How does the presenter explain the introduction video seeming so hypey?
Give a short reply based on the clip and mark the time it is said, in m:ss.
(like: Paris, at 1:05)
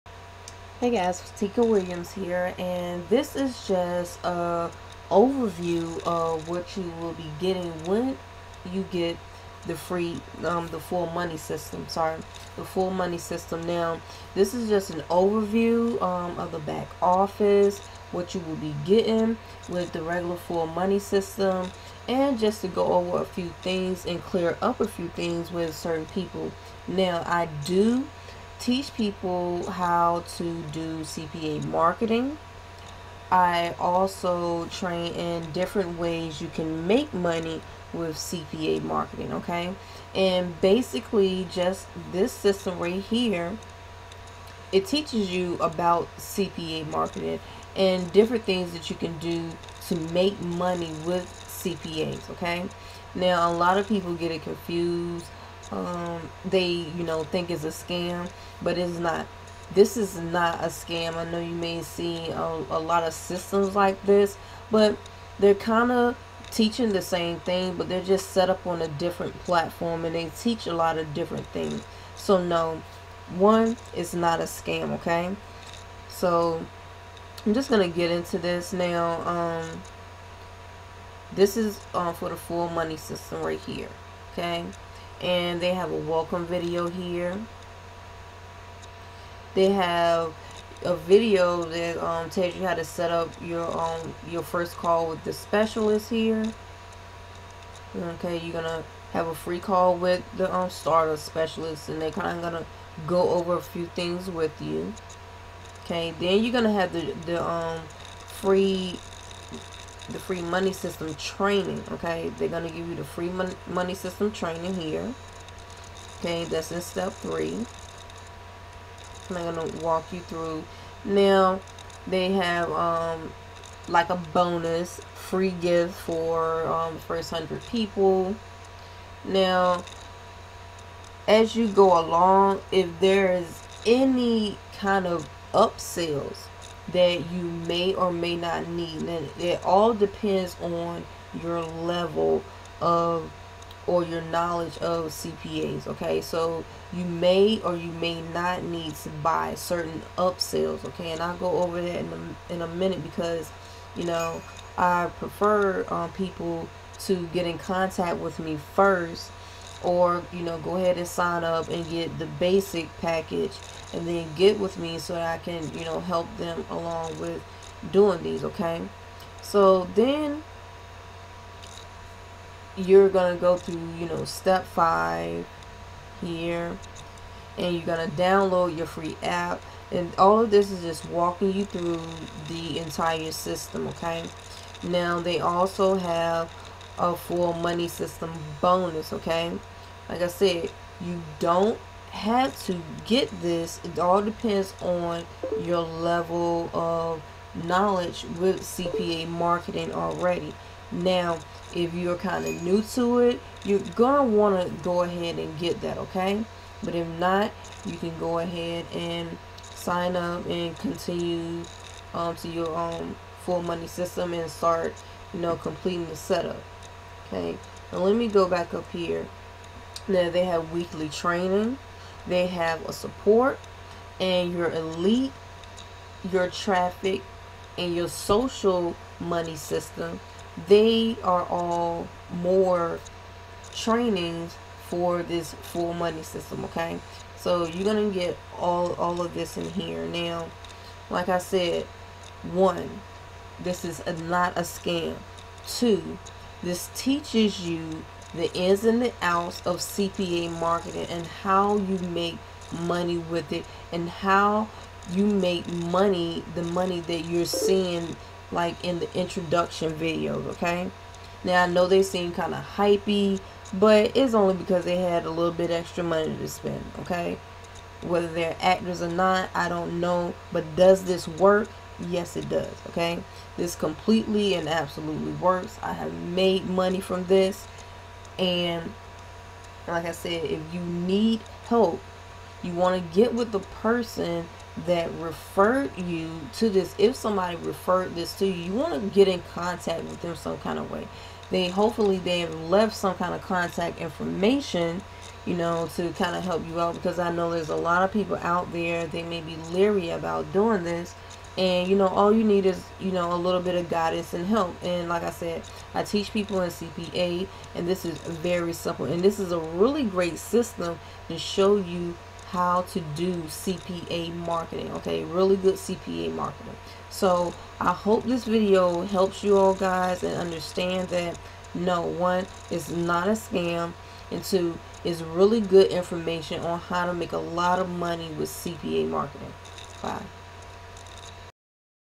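extra money to spend, at 4:25.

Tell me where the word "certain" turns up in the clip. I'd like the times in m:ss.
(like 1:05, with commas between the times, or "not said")
0:25, 2:29.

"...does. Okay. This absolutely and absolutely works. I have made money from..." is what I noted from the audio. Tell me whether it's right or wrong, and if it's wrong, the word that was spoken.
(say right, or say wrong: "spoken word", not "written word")
wrong: "completely", not "absolutely".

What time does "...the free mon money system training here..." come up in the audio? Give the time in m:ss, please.
1:52.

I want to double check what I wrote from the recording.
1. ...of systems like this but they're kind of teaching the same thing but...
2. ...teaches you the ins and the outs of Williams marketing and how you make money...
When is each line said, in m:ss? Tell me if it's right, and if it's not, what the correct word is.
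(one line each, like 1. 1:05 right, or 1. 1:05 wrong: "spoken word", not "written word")
1. 1:03 right
2. 4:06 wrong: "CPA", not "Williams".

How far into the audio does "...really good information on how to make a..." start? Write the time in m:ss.
5:25.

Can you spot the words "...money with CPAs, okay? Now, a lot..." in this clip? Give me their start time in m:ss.
0:50.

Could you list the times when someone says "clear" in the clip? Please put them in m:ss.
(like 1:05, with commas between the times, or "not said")
0:24.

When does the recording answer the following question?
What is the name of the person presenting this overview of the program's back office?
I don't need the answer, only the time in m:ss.
0:01.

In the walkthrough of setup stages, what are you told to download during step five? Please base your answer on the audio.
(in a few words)
free app.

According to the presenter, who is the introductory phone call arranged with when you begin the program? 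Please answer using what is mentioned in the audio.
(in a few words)
starter specialist.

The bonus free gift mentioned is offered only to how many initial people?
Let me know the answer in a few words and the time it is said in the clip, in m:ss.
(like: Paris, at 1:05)
100, at 2:07.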